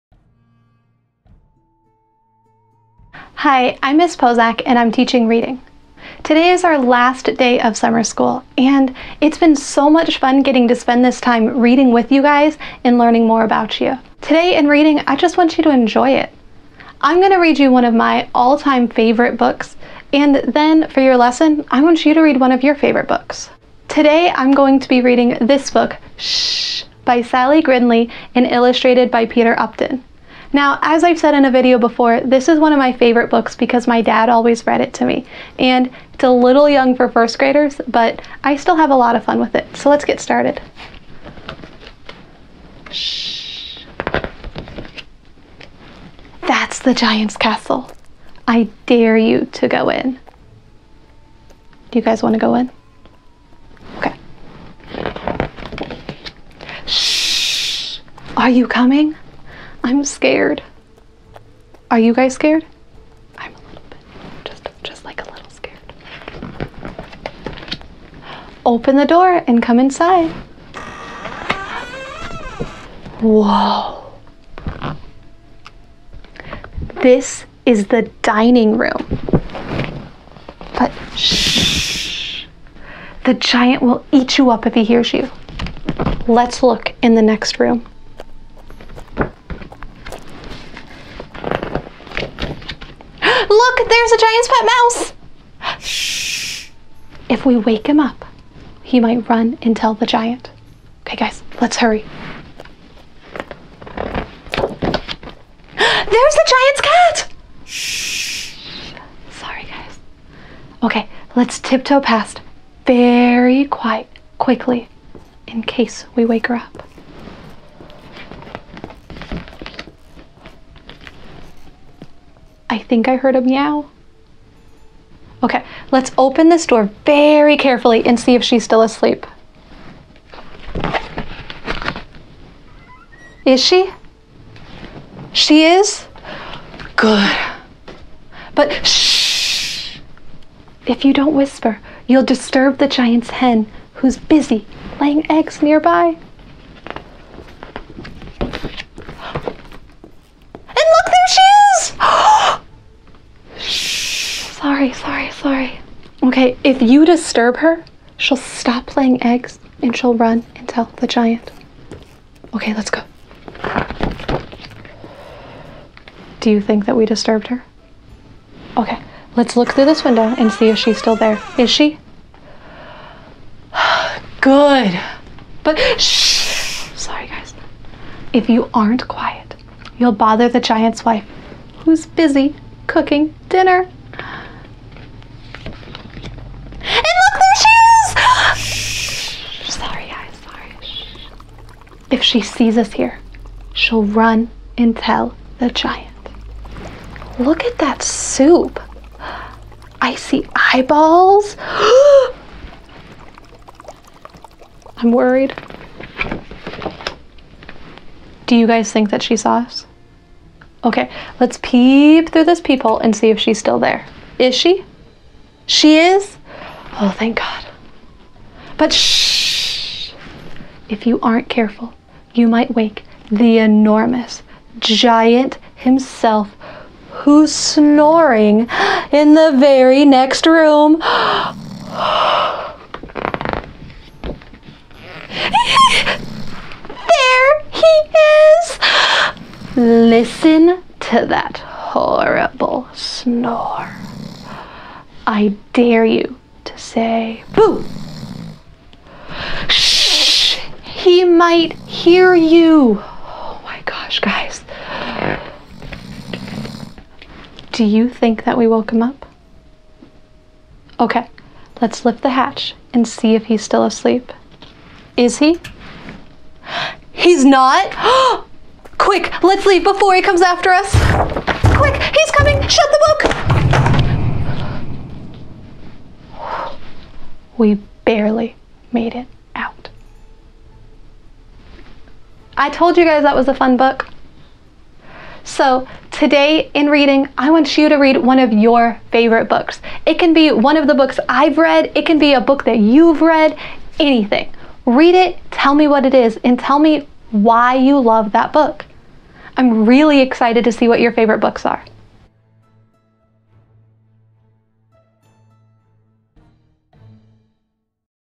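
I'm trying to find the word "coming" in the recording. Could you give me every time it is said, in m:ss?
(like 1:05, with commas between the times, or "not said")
0:58, 4:32.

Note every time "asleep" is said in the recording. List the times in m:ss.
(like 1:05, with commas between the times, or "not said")
2:08, 4:23.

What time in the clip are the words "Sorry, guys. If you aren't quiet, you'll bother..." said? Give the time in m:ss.
2:56.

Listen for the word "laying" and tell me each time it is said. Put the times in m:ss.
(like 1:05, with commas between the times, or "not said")
2:25, 2:38.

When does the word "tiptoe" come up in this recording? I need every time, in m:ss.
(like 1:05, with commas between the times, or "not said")
1:51.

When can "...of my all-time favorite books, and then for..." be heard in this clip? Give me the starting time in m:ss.
0:17.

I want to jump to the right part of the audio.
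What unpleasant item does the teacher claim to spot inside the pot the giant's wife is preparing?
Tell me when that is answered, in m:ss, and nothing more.
3:20.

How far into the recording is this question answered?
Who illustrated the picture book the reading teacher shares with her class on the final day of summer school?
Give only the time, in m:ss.
0:29.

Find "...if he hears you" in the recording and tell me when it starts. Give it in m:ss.
1:24.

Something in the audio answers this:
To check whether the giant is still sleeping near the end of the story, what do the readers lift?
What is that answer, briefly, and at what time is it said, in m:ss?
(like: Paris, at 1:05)
The hatch, at 4:22.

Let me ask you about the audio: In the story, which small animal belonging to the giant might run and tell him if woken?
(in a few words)
Pet mouse.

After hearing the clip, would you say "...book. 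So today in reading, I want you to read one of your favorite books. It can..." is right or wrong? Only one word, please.
right.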